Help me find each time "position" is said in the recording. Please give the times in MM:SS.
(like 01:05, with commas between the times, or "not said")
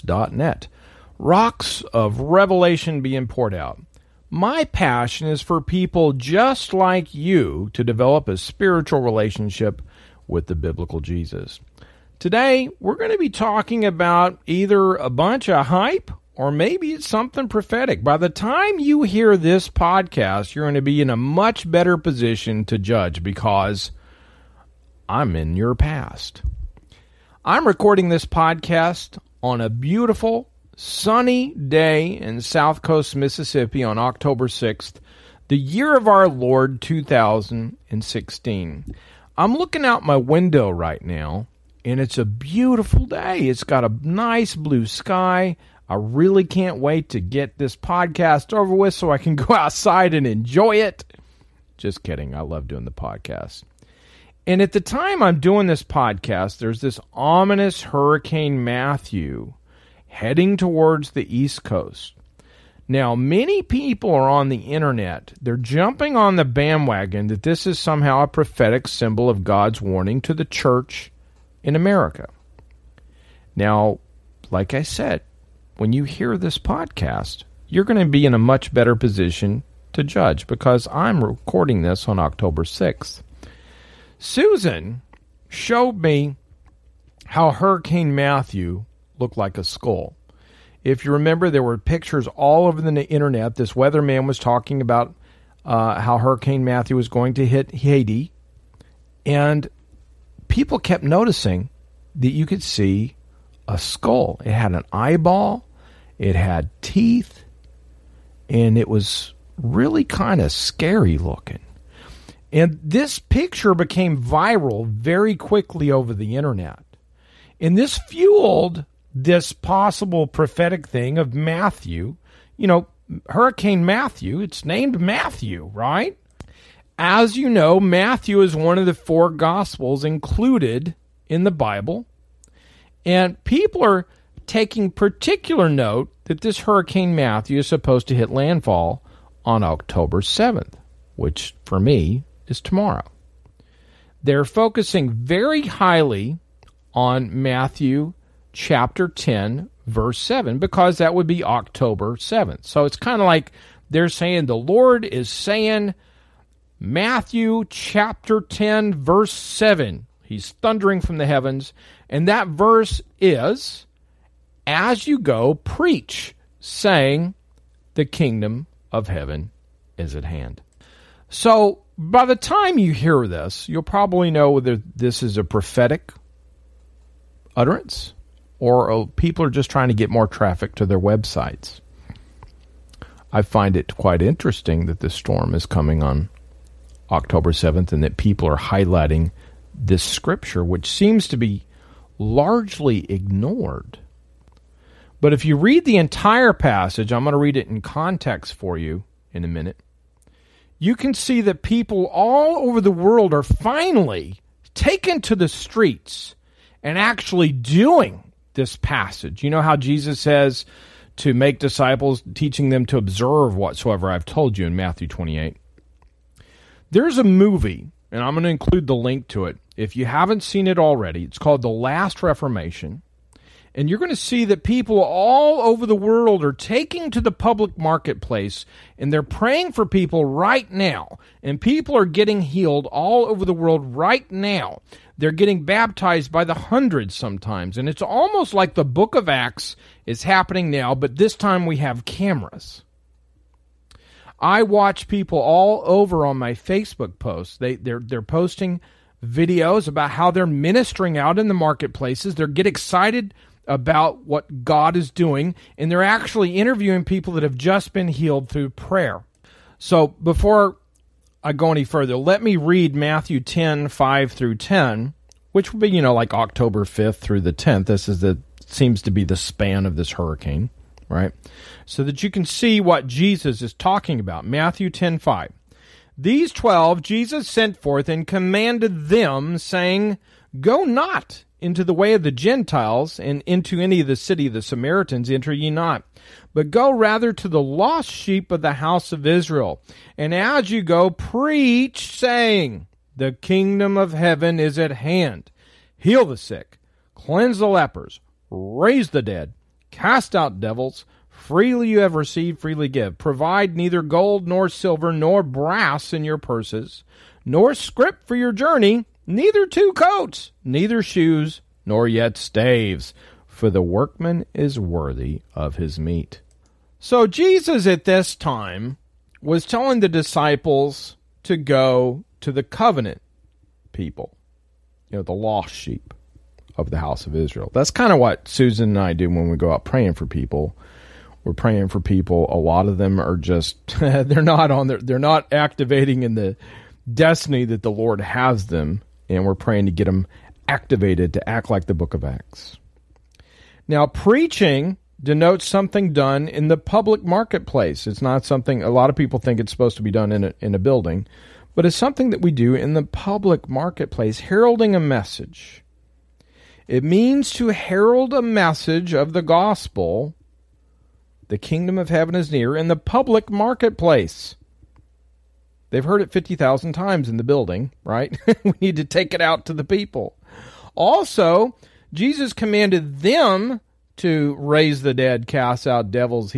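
00:21, 01:18.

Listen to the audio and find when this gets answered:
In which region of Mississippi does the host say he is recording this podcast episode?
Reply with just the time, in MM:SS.
00:32.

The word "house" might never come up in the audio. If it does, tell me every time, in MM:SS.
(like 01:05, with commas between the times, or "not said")
04:48, 05:26.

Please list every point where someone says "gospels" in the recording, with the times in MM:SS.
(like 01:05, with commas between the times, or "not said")
02:09, 05:59.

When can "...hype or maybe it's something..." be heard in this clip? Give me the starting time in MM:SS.
00:15.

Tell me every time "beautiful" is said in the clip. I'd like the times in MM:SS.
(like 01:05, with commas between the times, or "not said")
00:29, 00:42.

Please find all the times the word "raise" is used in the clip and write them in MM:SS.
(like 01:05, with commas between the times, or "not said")
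04:58, 06:14.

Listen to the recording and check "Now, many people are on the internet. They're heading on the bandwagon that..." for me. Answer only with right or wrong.
wrong.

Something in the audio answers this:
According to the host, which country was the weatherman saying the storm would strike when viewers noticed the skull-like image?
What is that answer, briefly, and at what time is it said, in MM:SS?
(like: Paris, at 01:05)
Haiti, at 01:37.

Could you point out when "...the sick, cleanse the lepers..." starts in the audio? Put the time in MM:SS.
04:56.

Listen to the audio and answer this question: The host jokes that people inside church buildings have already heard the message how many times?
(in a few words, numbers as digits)
50,000.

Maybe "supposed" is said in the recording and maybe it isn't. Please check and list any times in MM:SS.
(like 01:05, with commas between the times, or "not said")
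02:17, 05:49.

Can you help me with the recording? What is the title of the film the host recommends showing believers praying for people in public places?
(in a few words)
The Last Reformation.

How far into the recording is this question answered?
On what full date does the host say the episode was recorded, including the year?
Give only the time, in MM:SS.
00:33.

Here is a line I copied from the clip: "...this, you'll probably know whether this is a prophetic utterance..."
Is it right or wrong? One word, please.
right.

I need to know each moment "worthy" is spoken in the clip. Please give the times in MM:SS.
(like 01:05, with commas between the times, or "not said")
05:14.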